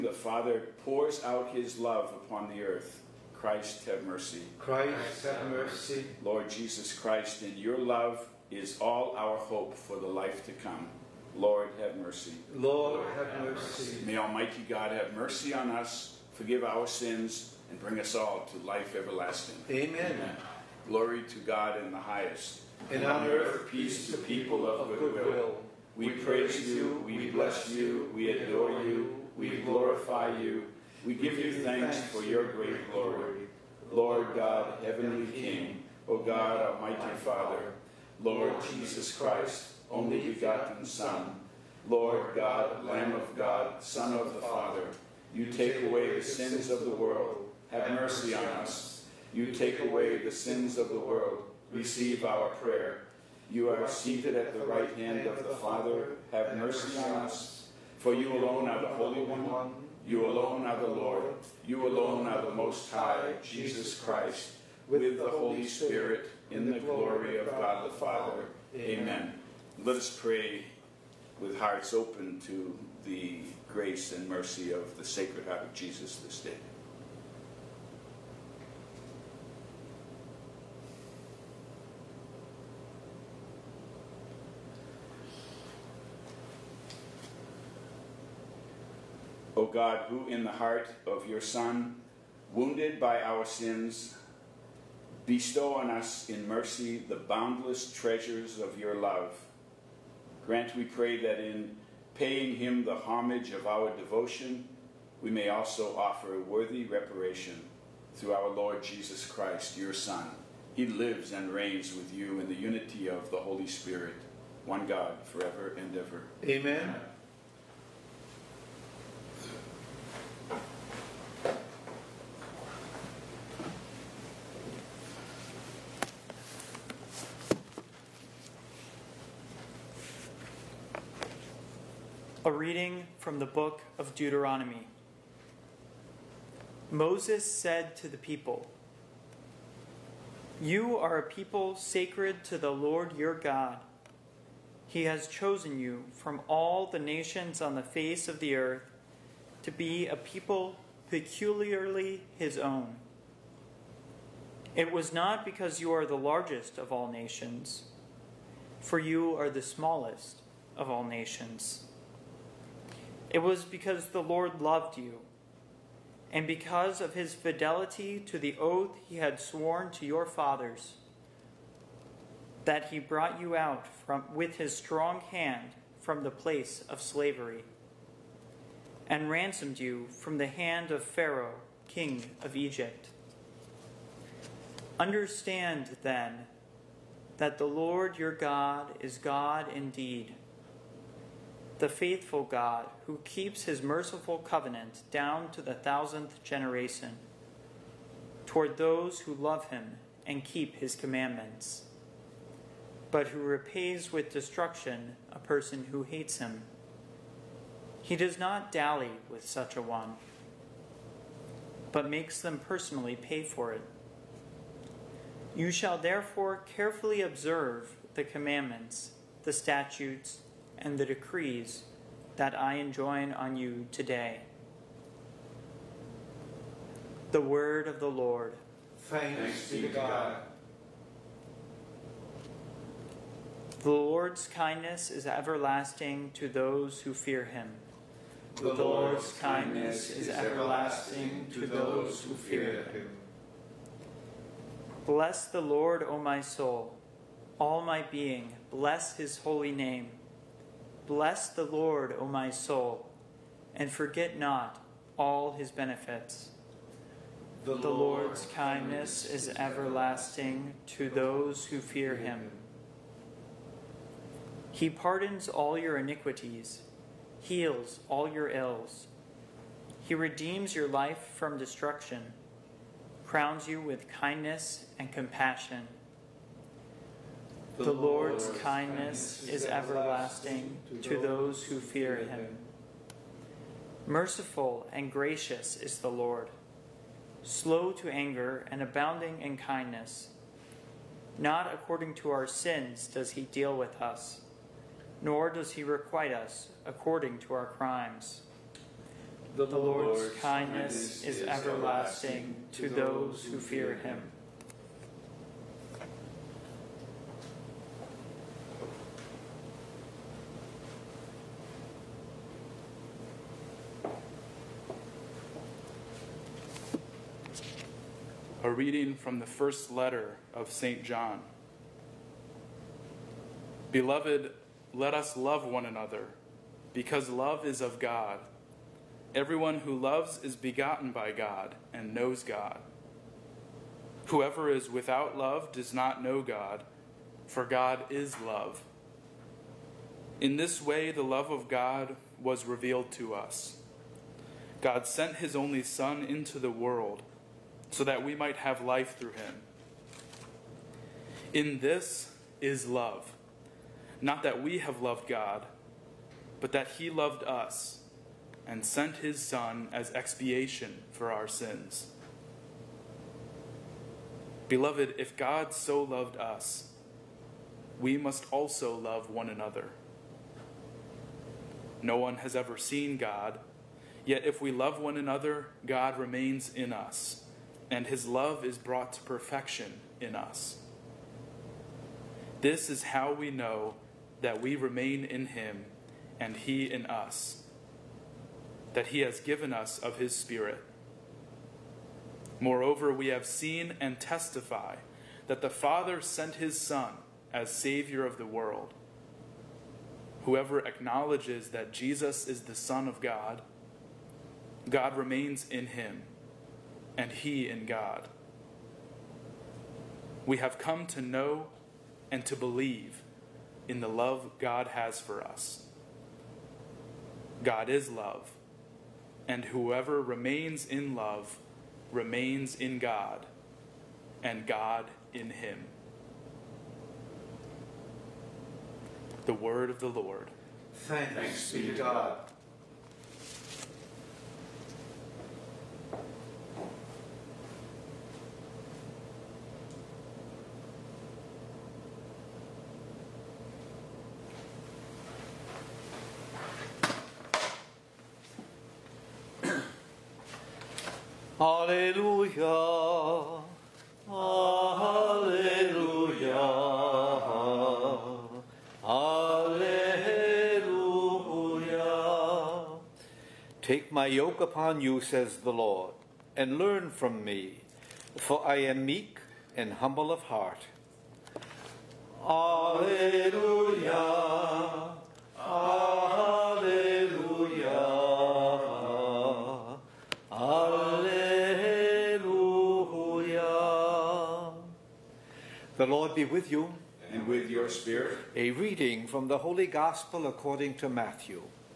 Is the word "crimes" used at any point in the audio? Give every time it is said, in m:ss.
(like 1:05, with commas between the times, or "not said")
4:57.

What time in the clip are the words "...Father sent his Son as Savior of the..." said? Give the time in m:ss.
6:35.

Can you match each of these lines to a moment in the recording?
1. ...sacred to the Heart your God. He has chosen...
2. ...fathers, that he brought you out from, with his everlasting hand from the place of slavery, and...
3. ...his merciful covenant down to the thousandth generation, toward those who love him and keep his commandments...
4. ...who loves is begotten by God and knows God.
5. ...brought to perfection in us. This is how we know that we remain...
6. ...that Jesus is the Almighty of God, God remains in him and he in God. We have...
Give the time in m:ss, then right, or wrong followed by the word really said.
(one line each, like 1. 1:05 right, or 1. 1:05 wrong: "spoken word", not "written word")
1. 2:21 wrong: "Lord", not "Heart"
2. 2:50 wrong: "strong", not "everlasting"
3. 3:13 right
4. 5:29 right
5. 6:18 right
6. 6:41 wrong: "Son", not "Almighty".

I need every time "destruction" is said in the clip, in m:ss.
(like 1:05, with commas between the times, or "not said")
3:24, 4:31.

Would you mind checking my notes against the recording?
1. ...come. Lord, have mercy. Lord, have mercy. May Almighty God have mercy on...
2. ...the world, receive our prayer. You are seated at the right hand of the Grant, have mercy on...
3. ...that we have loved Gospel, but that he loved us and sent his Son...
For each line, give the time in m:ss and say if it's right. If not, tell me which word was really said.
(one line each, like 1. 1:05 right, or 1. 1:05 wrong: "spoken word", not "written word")
1. 0:10 right
2. 0:50 wrong: "Father", not "Grant"
3. 5:54 wrong: "God", not "Gospel".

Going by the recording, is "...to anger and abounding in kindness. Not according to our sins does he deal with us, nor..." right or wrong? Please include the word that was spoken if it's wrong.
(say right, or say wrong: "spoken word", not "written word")
right.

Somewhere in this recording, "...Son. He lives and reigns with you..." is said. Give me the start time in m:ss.
1:49.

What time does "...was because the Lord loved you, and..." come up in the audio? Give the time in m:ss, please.
2:43.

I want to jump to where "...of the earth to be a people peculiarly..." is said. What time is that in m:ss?
2:28.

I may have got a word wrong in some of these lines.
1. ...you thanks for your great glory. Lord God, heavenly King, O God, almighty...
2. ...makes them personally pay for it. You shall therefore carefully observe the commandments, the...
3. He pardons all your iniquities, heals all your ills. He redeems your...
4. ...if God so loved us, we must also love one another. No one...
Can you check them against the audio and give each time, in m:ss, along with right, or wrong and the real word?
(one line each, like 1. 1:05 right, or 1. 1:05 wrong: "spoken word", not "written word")
1. 0:31 right
2. 3:32 right
3. 4:24 right
4. 6:05 right.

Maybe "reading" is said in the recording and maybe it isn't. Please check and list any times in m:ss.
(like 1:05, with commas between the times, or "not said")
2:12, 5:18, 8:08.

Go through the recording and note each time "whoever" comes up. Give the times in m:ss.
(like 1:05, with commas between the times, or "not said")
5:34, 6:40, 6:59.